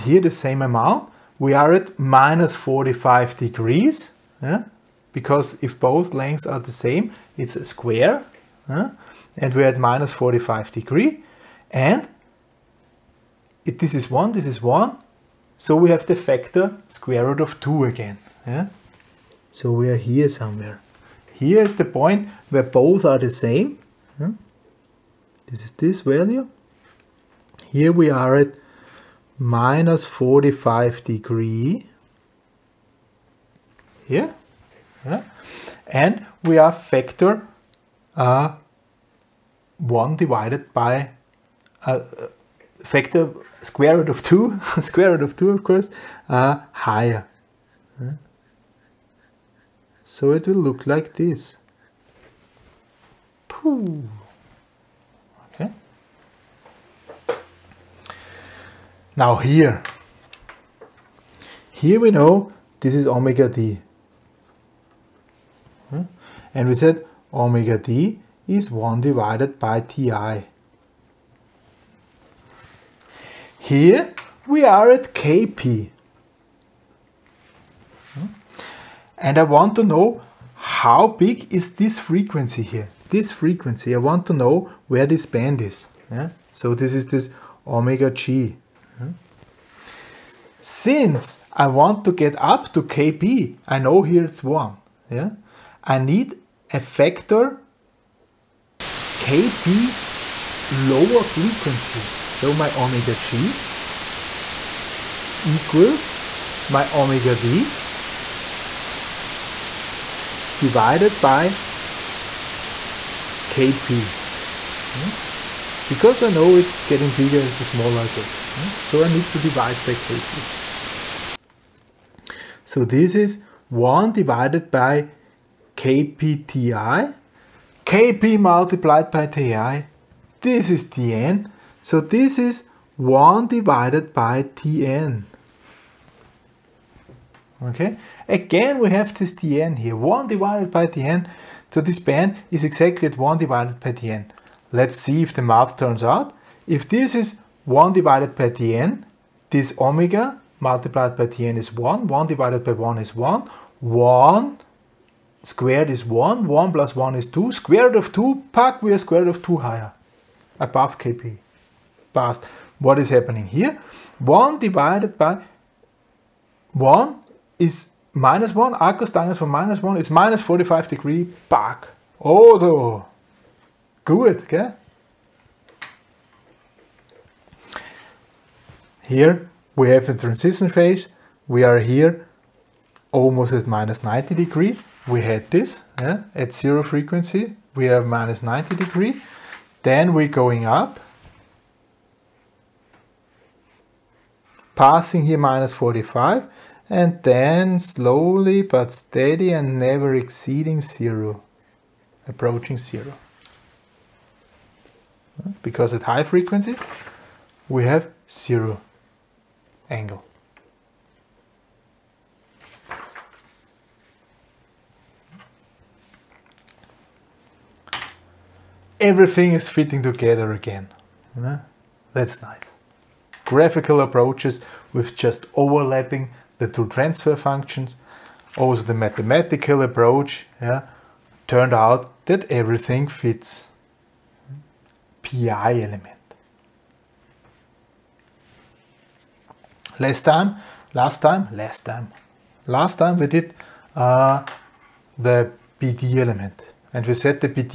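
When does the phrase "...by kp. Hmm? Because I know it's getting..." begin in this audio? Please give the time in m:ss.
1:51.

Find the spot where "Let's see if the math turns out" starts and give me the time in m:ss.
2:24.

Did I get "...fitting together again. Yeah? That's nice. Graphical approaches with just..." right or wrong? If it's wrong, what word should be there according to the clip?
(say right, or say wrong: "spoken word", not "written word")
right.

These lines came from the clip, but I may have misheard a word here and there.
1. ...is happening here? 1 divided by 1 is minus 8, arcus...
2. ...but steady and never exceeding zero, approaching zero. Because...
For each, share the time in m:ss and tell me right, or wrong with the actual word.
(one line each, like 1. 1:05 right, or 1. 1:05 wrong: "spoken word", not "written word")
1. 2:42 wrong: "1", not "8"
2. 3:18 right.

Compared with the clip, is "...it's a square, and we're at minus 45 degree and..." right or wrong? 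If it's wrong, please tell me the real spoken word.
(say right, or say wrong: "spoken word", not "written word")
right.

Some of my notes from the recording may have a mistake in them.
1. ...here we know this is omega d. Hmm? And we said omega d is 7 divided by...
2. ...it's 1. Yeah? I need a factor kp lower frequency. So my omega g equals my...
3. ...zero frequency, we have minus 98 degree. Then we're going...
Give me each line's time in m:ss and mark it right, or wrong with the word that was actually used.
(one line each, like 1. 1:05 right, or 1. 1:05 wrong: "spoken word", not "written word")
1. 1:01 wrong: "1", not "7"
2. 1:34 right
3. 3:06 wrong: "90", not "98".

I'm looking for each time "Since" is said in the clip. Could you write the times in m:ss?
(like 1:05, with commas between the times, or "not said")
1:30.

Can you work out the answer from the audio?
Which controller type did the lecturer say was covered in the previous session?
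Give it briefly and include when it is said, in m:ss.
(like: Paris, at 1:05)
PD element, at 4:05.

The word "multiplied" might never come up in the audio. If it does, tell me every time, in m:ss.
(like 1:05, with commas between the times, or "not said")
2:08, 2:30.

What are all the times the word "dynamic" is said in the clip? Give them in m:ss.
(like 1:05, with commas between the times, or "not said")
not said.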